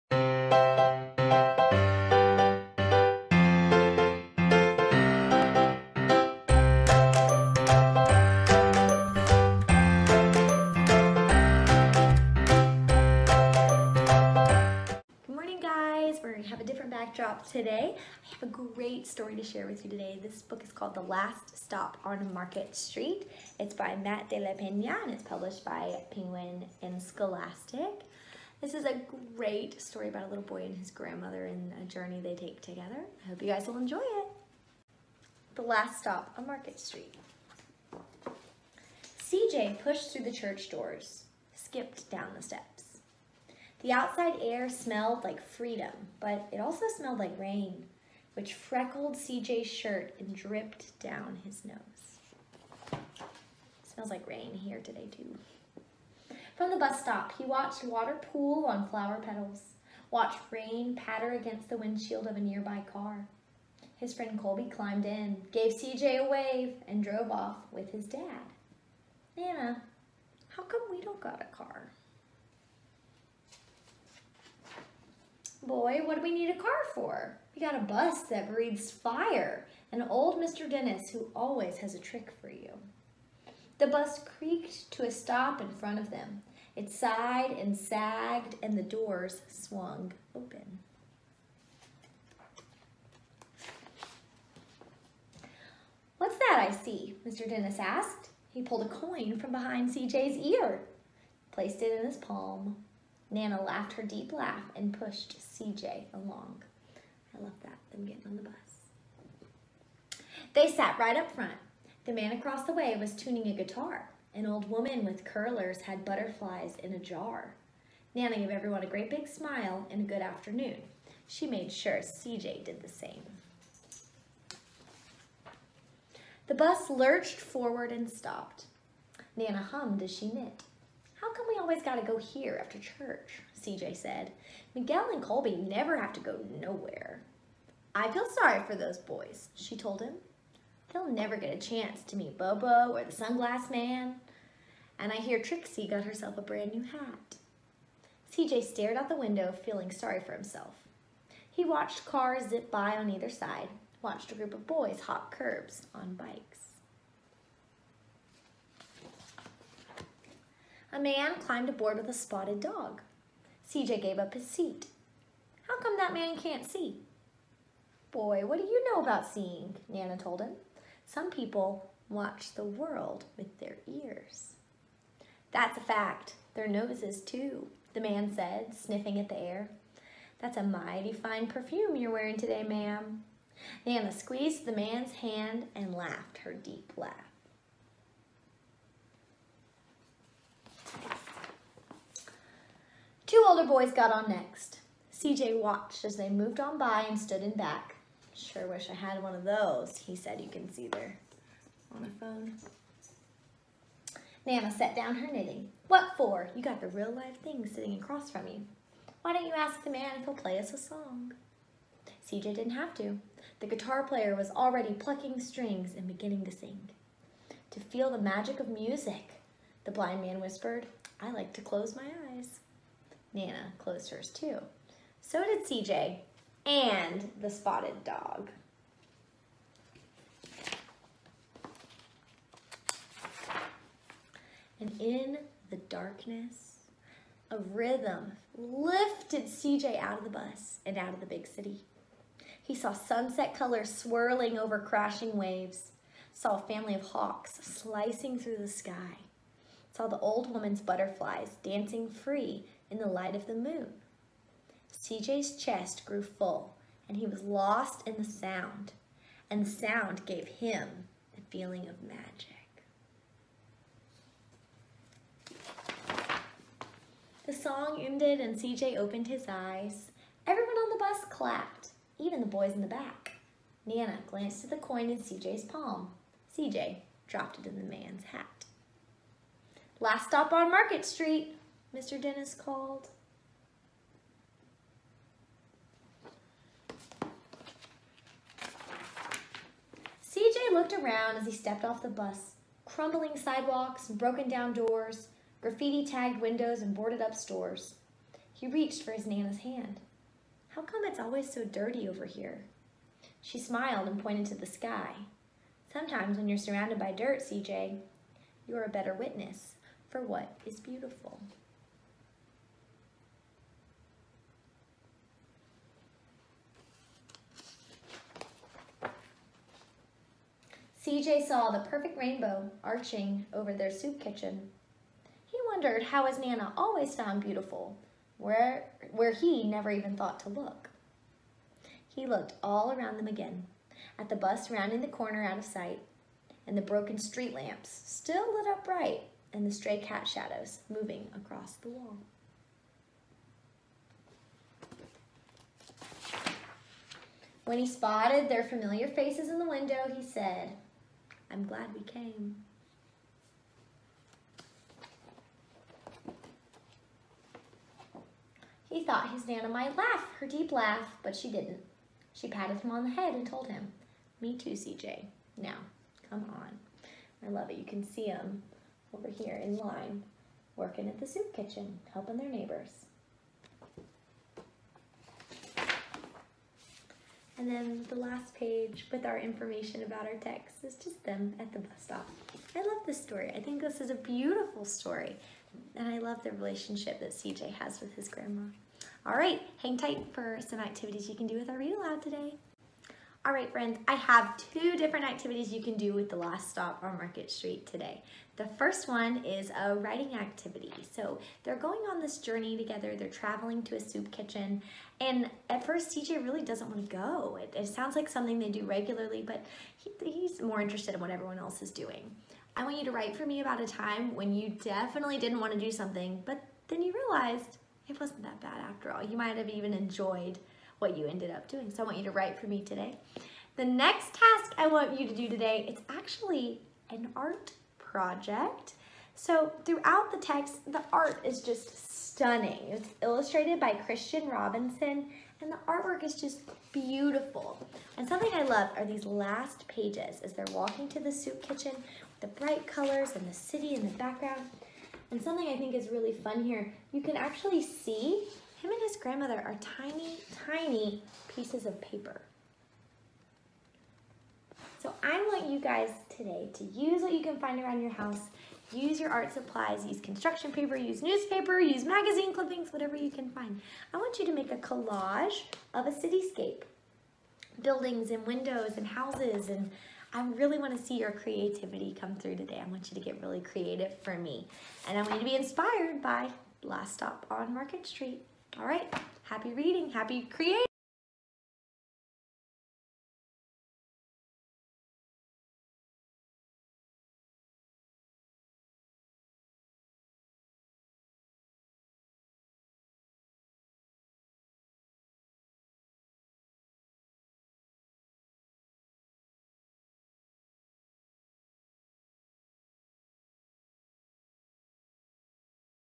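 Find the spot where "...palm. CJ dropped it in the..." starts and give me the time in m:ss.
4:35.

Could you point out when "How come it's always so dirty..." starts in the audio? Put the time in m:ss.
5:00.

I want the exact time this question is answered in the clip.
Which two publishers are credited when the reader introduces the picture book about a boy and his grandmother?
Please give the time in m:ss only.
0:26.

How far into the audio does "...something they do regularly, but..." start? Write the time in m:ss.
6:48.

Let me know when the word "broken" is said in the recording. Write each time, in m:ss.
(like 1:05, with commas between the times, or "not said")
4:54, 5:36.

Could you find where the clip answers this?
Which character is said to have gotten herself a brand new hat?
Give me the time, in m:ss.
2:25.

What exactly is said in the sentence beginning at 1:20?
Dennis who always has a trick for you.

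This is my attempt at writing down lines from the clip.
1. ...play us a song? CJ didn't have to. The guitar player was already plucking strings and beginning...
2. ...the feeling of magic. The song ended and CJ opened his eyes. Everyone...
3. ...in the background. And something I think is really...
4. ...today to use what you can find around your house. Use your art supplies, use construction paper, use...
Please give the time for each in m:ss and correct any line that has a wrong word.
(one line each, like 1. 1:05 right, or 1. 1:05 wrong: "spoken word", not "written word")
1. 3:30 right
2. 4:21 right
3. 7:23 right
4. 7:36 right.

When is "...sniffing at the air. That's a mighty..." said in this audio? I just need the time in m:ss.
2:58.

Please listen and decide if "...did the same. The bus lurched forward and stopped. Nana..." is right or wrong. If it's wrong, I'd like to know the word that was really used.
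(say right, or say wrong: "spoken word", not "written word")
right.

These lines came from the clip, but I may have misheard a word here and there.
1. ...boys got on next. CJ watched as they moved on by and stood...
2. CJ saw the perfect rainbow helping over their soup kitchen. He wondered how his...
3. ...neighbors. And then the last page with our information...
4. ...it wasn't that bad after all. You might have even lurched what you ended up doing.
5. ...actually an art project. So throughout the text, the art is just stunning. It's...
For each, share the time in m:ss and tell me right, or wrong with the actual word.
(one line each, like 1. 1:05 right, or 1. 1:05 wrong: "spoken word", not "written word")
1. 3:13 right
2. 5:21 wrong: "arching", not "helping"
3. 6:12 right
4. 6:58 wrong: "enjoyed", not "lurched"
5. 7:06 right.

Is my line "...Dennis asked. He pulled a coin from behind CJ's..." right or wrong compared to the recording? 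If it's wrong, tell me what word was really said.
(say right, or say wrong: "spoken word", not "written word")
right.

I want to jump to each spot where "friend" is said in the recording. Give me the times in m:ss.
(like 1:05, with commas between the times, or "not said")
1:04, 6:33.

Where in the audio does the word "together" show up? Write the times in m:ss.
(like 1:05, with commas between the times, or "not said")
0:32, 6:42.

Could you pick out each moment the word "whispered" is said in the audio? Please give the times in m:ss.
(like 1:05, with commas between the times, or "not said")
3:40.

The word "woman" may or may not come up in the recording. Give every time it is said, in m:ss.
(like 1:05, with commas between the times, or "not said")
1:54, 4:10.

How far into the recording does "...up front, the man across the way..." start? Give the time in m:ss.
1:51.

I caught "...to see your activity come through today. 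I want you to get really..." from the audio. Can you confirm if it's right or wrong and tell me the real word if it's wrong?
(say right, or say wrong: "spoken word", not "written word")
wrong: "creativity", not "activity".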